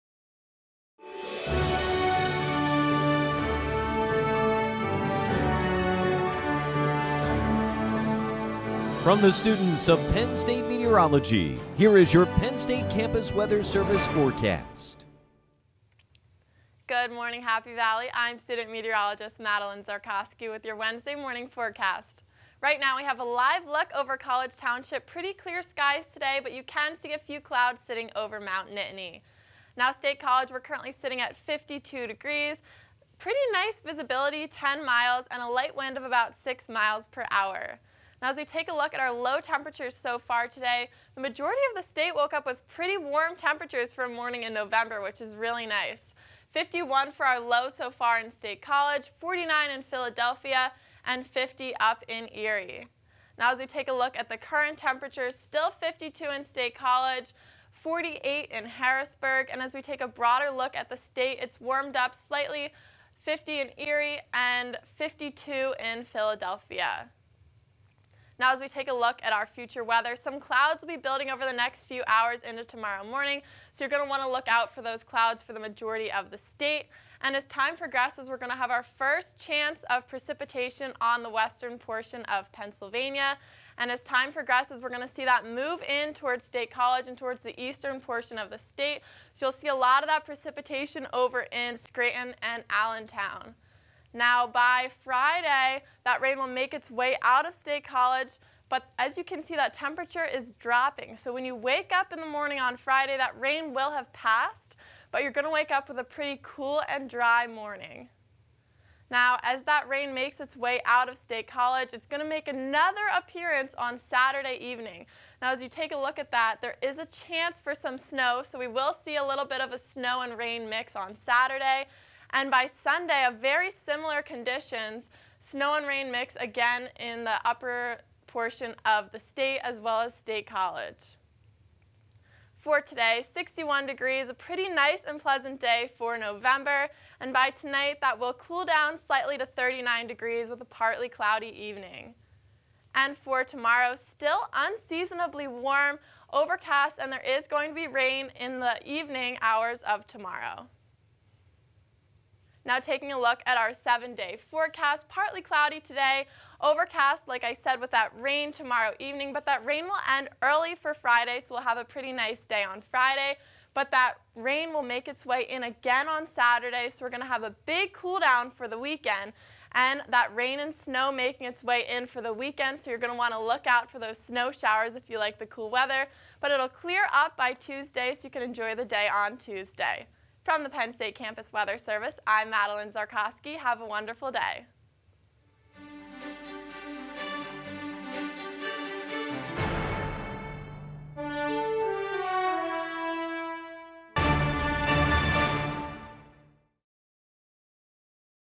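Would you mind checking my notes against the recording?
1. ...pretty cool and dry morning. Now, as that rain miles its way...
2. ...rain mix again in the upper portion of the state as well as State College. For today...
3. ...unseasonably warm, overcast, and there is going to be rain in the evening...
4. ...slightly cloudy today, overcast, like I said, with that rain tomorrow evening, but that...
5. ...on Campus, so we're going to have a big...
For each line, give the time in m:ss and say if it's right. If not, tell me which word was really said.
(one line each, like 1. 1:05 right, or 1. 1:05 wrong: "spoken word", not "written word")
1. 1:46 wrong: "makes", not "miles"
2. 2:05 right
3. 2:24 right
4. 2:35 wrong: "partly", not "slightly"
5. 2:46 wrong: "Saturday", not "Campus".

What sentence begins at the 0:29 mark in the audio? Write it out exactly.
Now State College, we're currently sitting at 52 degrees.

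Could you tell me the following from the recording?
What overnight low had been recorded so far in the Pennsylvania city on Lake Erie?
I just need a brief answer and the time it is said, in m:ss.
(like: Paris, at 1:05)
50, at 0:51.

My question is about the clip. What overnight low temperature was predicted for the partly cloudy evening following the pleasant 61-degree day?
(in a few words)
39 degrees.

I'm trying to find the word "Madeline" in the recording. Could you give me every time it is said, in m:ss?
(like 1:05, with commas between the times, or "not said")
0:19, 3:02.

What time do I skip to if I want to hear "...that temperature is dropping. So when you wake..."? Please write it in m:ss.
1:39.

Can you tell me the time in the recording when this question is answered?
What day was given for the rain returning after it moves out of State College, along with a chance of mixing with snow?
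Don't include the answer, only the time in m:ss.
1:53.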